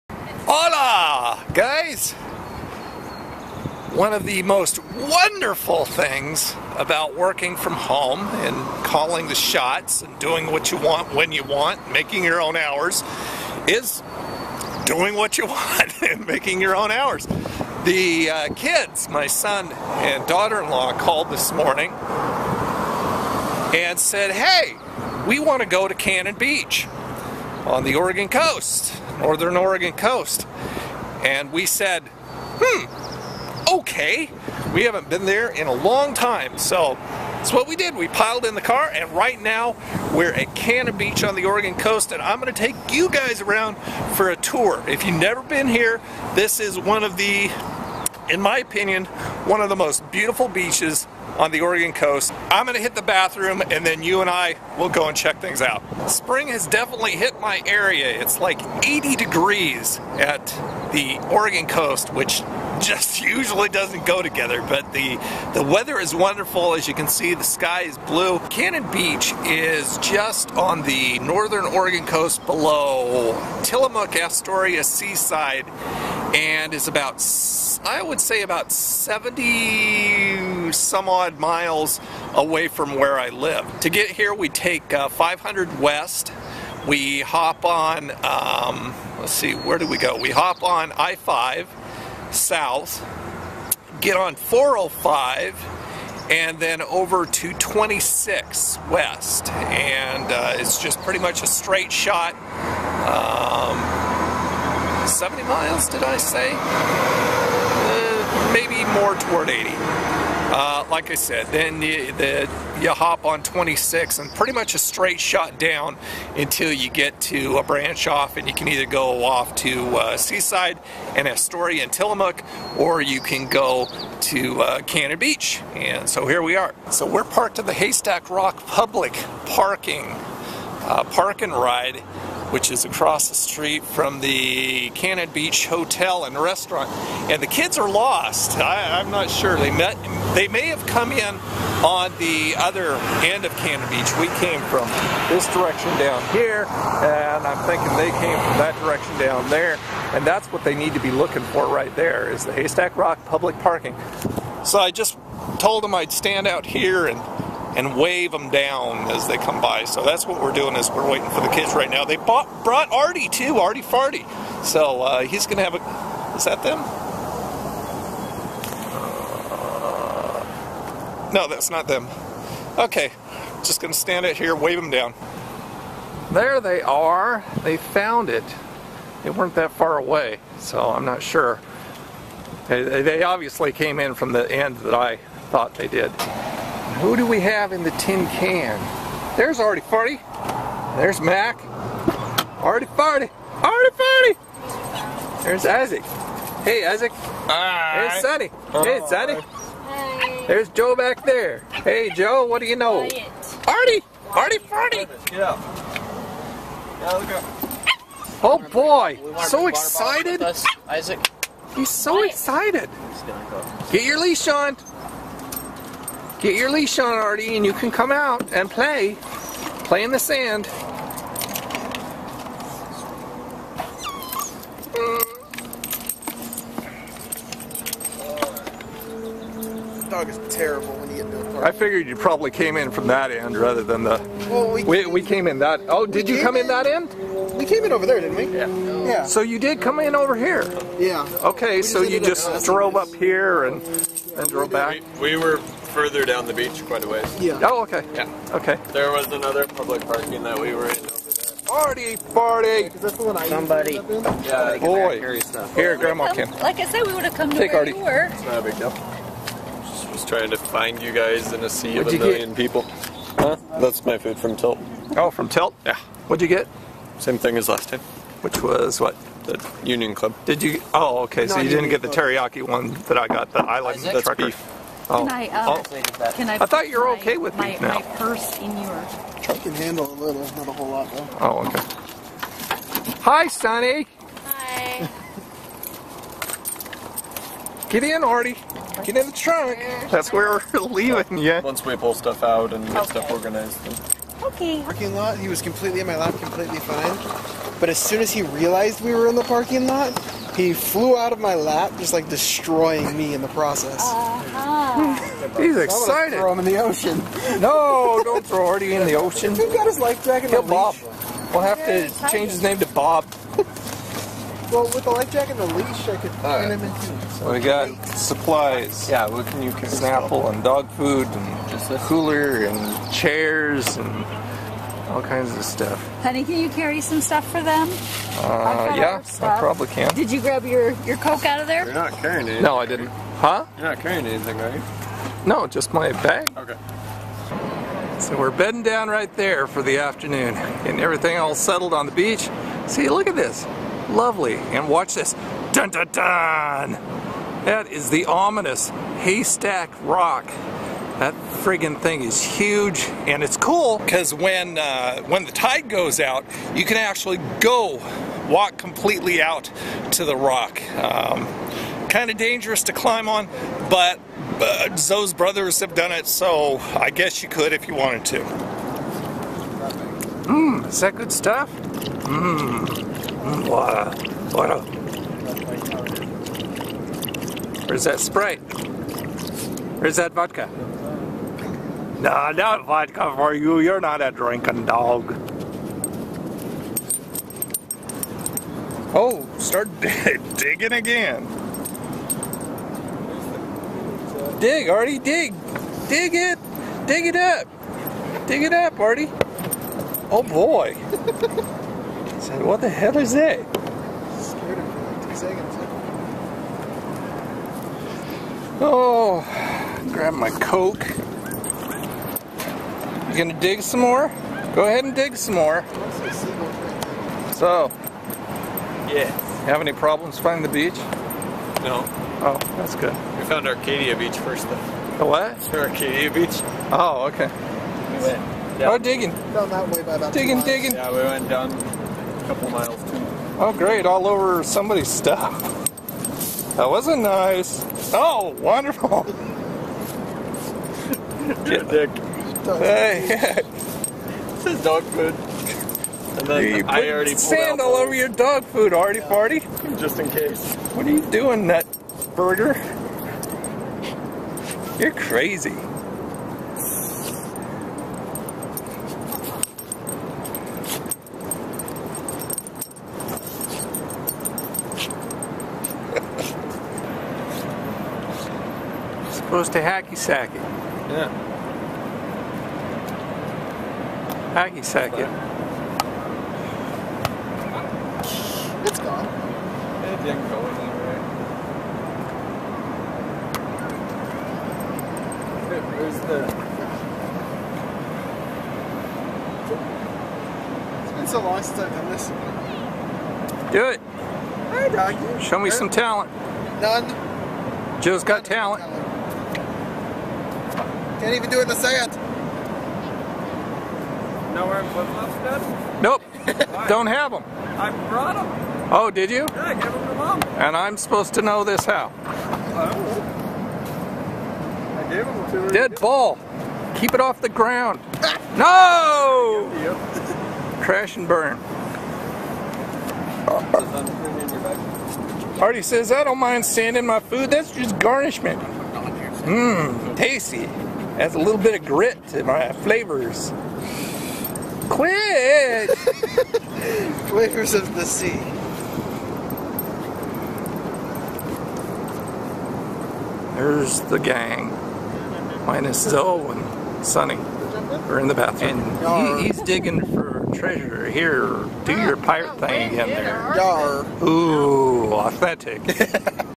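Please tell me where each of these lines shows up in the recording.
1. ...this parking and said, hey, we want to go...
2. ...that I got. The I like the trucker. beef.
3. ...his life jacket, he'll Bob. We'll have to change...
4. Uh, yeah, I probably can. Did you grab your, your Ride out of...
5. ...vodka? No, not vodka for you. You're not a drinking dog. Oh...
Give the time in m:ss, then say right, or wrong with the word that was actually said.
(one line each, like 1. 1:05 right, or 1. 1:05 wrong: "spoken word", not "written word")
1. 0:21 wrong: "morning", not "parking"
2. 4:33 right
3. 5:09 right
4. 5:28 wrong: "Coke", not "Ride"
5. 6:20 right.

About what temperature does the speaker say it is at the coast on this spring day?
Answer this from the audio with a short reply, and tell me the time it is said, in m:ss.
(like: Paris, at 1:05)
80 degrees, at 0:58.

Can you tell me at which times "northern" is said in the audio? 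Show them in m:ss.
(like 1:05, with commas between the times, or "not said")
0:29, 1:11.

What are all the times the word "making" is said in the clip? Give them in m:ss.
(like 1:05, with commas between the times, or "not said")
0:11, 0:16.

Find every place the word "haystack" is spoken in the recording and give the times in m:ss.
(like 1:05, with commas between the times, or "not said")
2:07, 2:32, 5:49.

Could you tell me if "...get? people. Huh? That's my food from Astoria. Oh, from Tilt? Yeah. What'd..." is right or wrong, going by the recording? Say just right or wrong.
wrong.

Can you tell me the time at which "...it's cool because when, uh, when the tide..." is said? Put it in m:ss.
5:53.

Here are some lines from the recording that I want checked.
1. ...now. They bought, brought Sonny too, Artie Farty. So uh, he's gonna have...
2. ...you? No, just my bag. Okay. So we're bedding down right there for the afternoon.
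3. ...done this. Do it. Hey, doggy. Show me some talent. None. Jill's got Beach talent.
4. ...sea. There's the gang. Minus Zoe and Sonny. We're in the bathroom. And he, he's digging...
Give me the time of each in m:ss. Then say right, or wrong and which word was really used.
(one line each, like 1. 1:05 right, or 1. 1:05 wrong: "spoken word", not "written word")
1. 2:41 wrong: "Artie", not "Sonny"
2. 5:34 right
3. 8:11 wrong: "None", not "Beach"
4. 8:58 right.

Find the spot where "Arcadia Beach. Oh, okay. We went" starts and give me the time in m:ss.
7:05.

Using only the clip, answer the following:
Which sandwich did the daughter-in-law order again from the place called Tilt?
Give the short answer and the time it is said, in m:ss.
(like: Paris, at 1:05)
The Union Club, at 4:29.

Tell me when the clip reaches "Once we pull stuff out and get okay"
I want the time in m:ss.
4:51.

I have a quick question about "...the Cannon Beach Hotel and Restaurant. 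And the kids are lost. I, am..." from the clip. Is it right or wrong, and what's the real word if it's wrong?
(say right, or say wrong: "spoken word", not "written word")
right.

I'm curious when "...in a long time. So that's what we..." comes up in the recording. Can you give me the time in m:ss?
0:35.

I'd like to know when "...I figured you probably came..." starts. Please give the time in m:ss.
3:51.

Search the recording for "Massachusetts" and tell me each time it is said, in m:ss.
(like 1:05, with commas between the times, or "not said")
not said.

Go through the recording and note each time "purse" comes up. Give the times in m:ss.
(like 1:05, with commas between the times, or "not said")
4:38.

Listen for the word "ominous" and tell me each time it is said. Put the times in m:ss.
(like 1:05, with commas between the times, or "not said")
5:48.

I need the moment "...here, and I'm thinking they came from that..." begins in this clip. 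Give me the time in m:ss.
2:26.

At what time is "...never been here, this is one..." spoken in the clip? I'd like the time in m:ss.
0:45.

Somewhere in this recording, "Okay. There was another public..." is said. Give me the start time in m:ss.
4:08.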